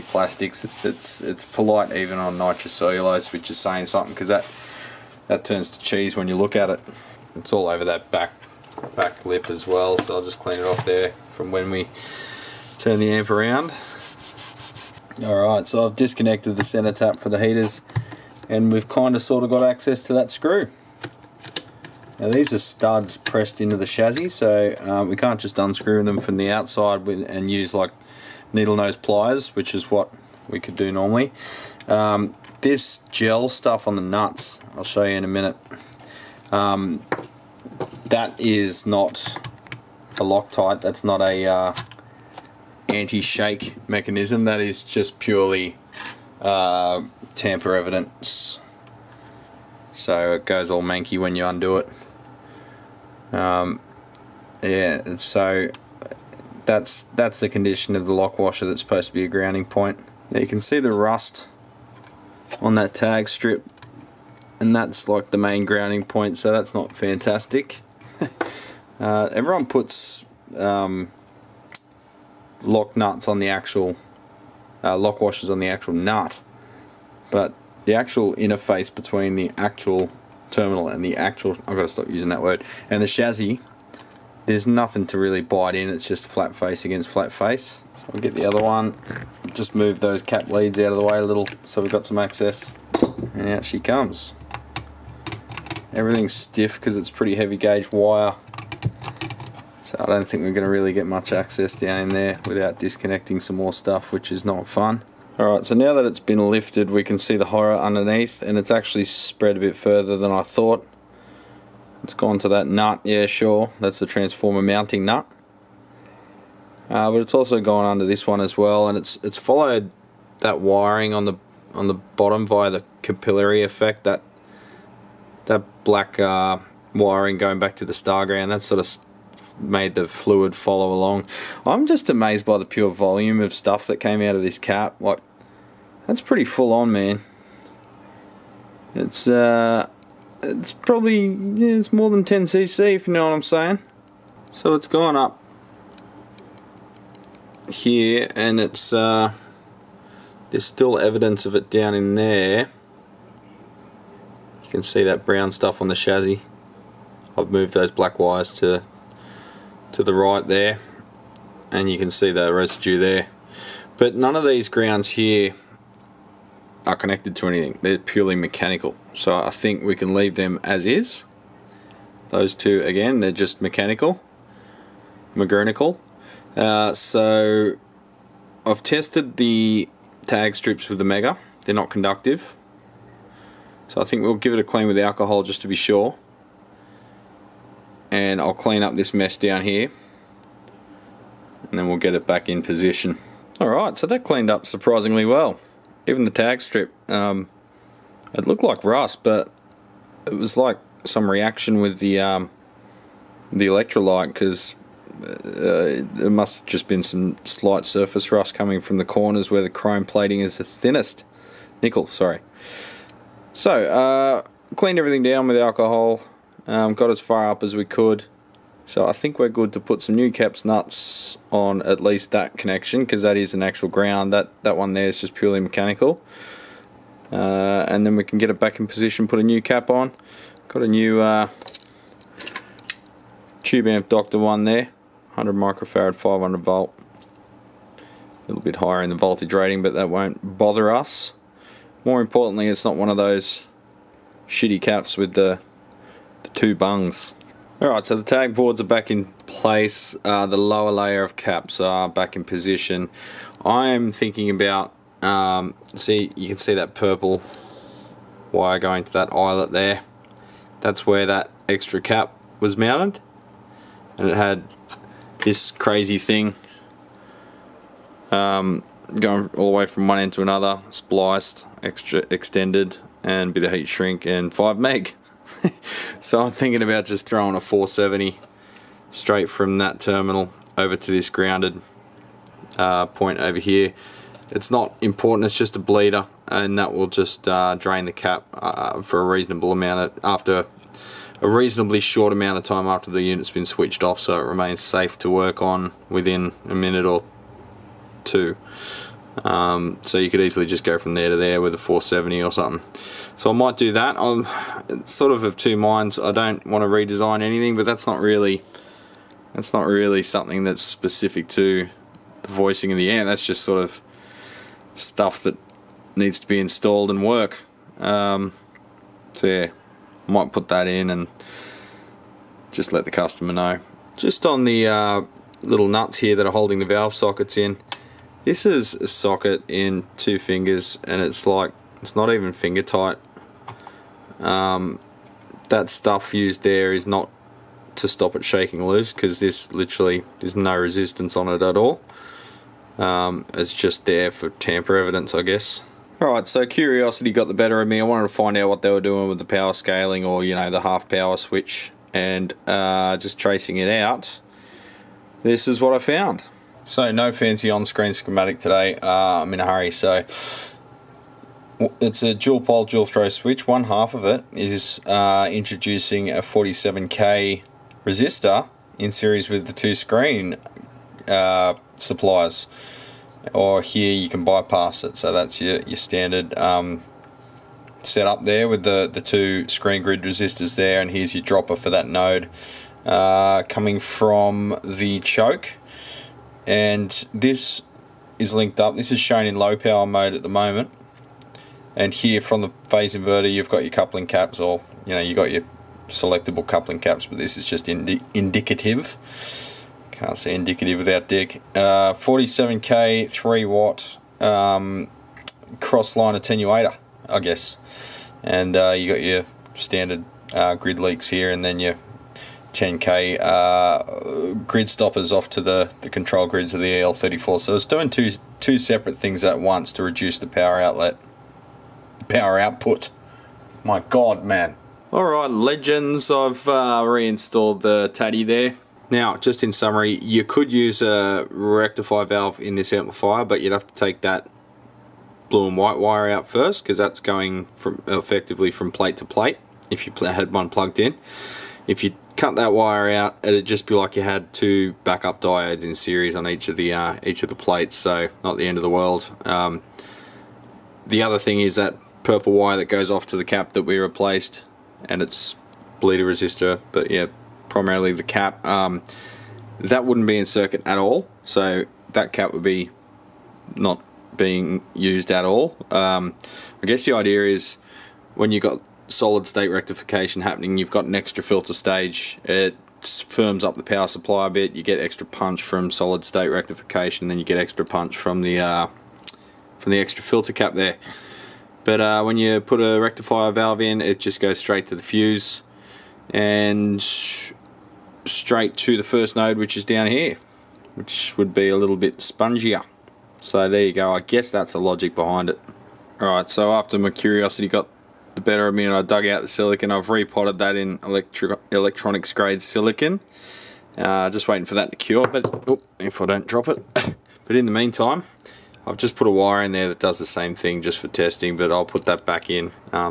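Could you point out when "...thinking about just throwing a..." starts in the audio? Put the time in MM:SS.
04:36.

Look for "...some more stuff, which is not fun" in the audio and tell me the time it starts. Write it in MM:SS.
01:43.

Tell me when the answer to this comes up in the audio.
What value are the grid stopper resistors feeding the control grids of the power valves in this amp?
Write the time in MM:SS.
06:52.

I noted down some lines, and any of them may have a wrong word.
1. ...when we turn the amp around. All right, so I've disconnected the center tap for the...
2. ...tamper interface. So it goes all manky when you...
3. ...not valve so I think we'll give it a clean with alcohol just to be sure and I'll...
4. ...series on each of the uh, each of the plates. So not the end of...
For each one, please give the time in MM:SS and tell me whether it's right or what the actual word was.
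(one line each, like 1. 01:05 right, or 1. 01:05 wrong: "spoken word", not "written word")
1. 00:11 right
2. 00:47 wrong: "evidence", not "interface"
3. 03:01 wrong: "conductive", not "valve"
4. 07:25 right.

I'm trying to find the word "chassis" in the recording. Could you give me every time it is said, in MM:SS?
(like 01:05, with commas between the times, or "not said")
00:23, 01:23, 02:35.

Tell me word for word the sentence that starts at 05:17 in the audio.
Um, so yeah, I might put that in and just let the customer know.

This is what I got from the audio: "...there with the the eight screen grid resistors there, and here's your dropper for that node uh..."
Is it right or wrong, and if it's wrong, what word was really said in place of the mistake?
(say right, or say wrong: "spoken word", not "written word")
wrong: "two", not "eight".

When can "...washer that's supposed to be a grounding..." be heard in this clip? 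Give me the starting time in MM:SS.
00:58.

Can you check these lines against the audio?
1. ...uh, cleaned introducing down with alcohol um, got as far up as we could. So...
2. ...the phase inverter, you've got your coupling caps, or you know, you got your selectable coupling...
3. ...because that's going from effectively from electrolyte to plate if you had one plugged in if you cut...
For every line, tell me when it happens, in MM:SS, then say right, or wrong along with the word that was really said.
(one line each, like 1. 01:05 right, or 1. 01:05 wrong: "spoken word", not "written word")
1. 03:33 wrong: "everything", not "introducing"
2. 06:32 right
3. 07:16 wrong: "plate", not "electrolyte".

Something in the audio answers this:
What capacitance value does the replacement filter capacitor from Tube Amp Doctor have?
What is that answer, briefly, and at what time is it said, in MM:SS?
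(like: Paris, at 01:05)
100 microfarad, at 03:55.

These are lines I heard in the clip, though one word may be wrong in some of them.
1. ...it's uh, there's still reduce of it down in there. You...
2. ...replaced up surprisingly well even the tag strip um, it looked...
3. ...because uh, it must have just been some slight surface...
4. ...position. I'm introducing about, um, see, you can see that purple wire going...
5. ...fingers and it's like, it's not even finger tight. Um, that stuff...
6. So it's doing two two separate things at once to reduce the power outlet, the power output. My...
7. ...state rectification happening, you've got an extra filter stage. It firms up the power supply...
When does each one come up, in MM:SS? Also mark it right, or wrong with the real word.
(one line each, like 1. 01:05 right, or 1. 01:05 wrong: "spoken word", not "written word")
1. 02:28 wrong: "evidence", not "reduce"
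2. 03:14 wrong: "cleaned", not "replaced"
3. 03:24 right
4. 04:12 wrong: "thinking", not "introducing"
5. 05:30 right
6. 06:57 right
7. 07:49 right.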